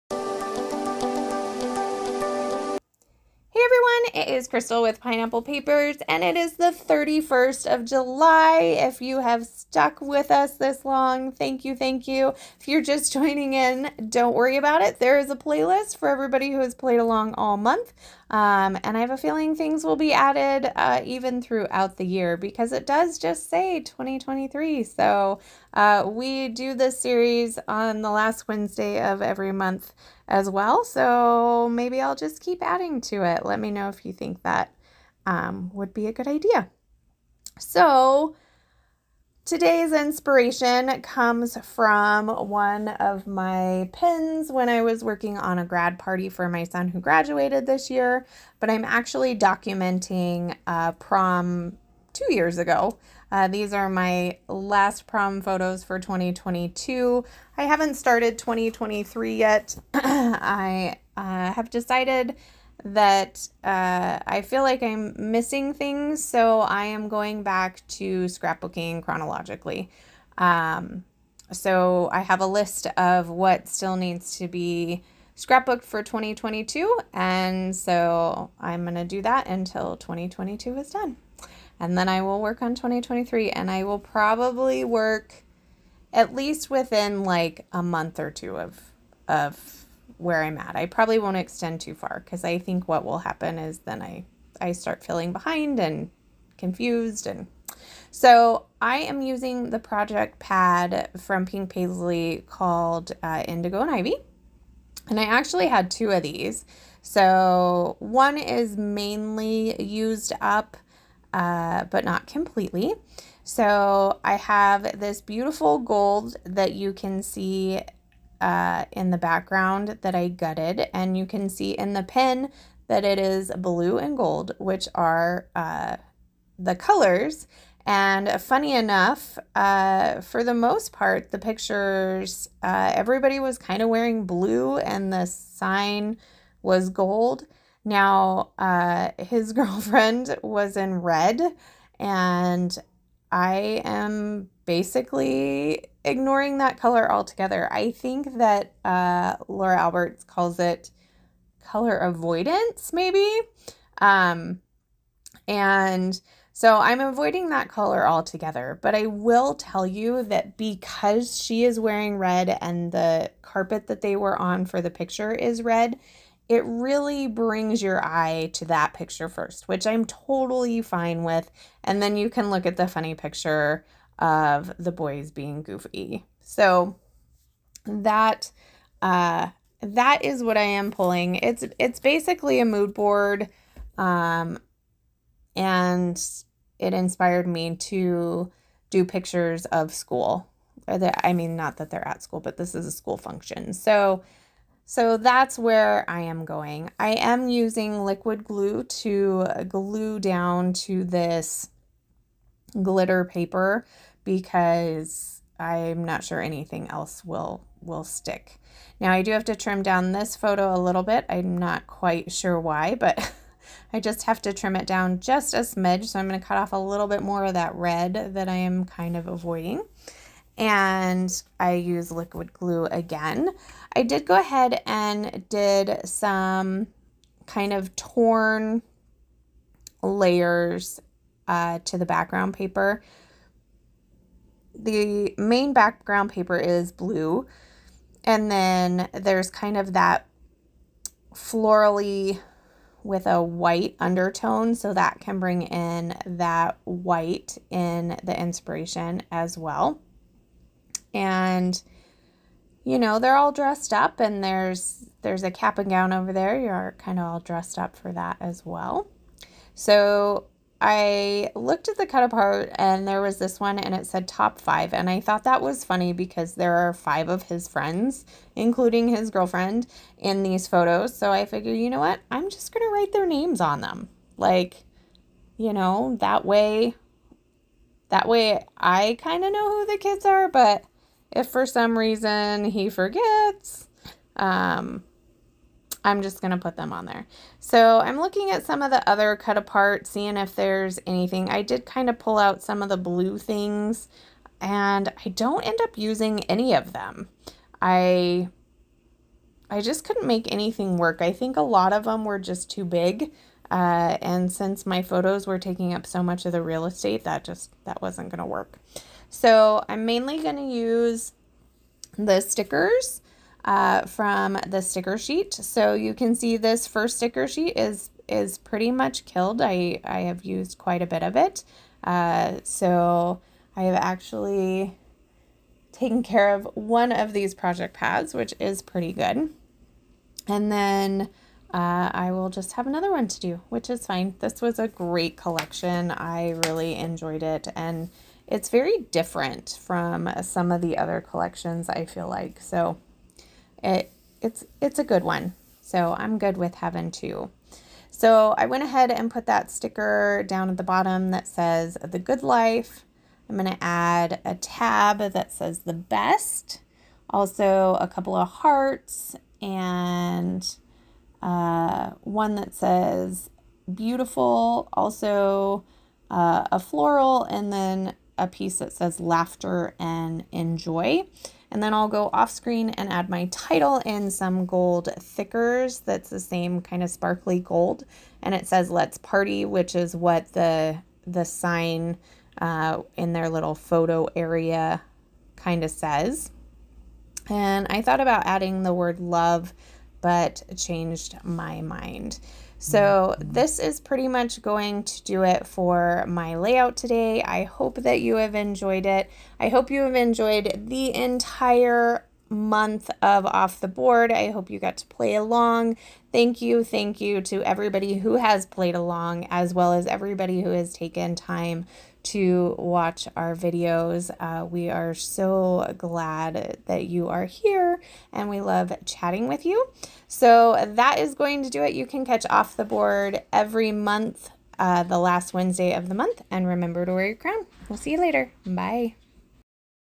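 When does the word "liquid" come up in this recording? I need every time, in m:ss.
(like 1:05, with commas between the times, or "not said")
3:18, 3:42.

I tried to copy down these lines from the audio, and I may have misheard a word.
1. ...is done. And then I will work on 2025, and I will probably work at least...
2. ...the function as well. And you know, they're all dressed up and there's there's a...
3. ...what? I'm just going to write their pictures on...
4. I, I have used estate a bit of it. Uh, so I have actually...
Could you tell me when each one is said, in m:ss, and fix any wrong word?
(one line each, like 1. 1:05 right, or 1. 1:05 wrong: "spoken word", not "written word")
1. 1:20 wrong: "2023", not "2025"
2. 4:08 wrong: "inspiration", not "function"
3. 4:31 wrong: "names", not "pictures"
4. 5:19 wrong: "quite", not "estate".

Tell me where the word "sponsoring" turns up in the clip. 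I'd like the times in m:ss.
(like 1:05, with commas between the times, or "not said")
not said.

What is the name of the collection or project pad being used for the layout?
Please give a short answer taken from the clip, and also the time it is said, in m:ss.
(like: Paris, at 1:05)
Indigo and Ivy, at 1:43.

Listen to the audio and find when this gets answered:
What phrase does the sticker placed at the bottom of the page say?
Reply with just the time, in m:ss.
5:52.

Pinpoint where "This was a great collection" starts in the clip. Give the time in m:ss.
5:34.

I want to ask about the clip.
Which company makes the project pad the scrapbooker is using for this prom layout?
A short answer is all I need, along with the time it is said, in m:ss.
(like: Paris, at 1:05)
Pink Paislee, at 1:41.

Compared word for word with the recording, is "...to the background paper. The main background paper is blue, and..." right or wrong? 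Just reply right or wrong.
right.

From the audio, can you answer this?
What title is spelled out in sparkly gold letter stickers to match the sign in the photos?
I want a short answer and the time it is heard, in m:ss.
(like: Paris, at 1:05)
Let's Party, at 6:18.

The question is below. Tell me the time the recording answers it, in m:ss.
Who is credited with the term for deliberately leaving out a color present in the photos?
2:29.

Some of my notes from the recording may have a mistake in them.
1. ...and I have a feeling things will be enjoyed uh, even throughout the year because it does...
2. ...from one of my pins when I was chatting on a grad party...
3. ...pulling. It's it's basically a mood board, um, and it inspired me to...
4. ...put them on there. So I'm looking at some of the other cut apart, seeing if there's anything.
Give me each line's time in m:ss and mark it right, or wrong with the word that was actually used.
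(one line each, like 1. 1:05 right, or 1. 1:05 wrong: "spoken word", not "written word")
1. 0:18 wrong: "added", not "enjoyed"
2. 0:41 wrong: "working", not "chatting"
3. 3:00 right
4. 4:46 right.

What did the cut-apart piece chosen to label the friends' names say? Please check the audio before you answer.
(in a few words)
Top five.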